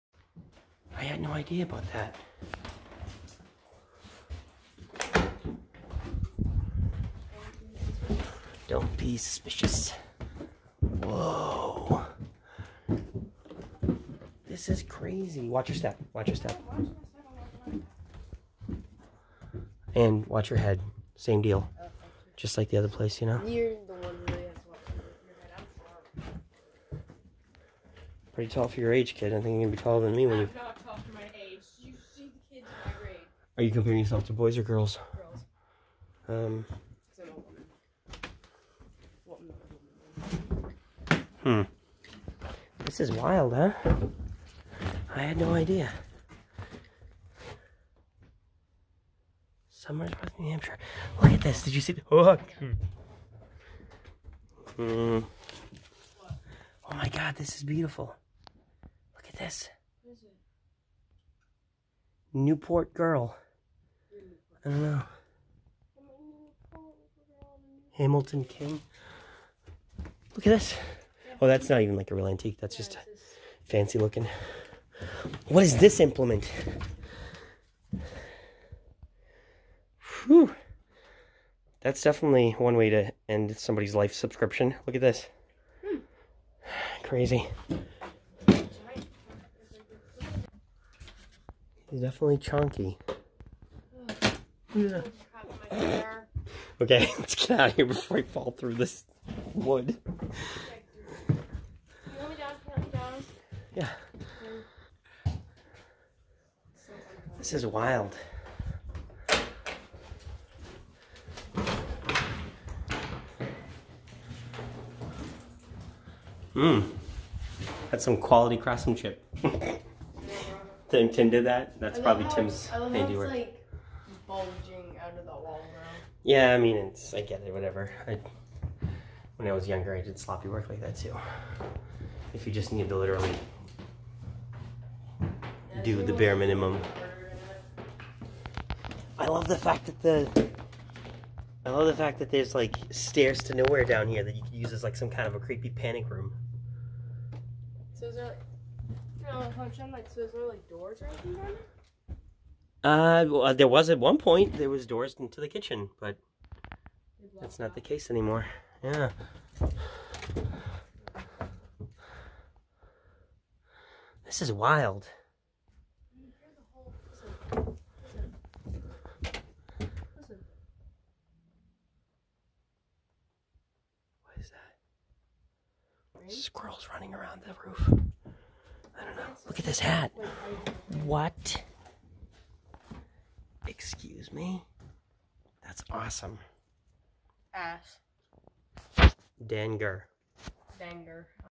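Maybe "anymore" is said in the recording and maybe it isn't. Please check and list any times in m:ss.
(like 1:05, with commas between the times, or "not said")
2:38.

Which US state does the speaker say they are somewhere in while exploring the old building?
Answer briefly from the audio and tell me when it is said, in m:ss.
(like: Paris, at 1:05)
New Hampshire, at 0:50.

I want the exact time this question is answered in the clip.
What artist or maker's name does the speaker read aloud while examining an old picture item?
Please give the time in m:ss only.
1:07.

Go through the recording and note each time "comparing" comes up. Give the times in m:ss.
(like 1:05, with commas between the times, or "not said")
0:33.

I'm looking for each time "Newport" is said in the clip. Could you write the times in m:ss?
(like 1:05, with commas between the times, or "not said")
1:02.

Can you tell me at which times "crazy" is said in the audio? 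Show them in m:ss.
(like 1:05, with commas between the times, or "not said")
0:14, 1:27.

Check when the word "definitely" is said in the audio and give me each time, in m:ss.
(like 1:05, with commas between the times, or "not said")
1:22, 1:31.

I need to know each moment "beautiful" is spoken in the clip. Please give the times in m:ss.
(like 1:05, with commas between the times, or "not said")
0:57.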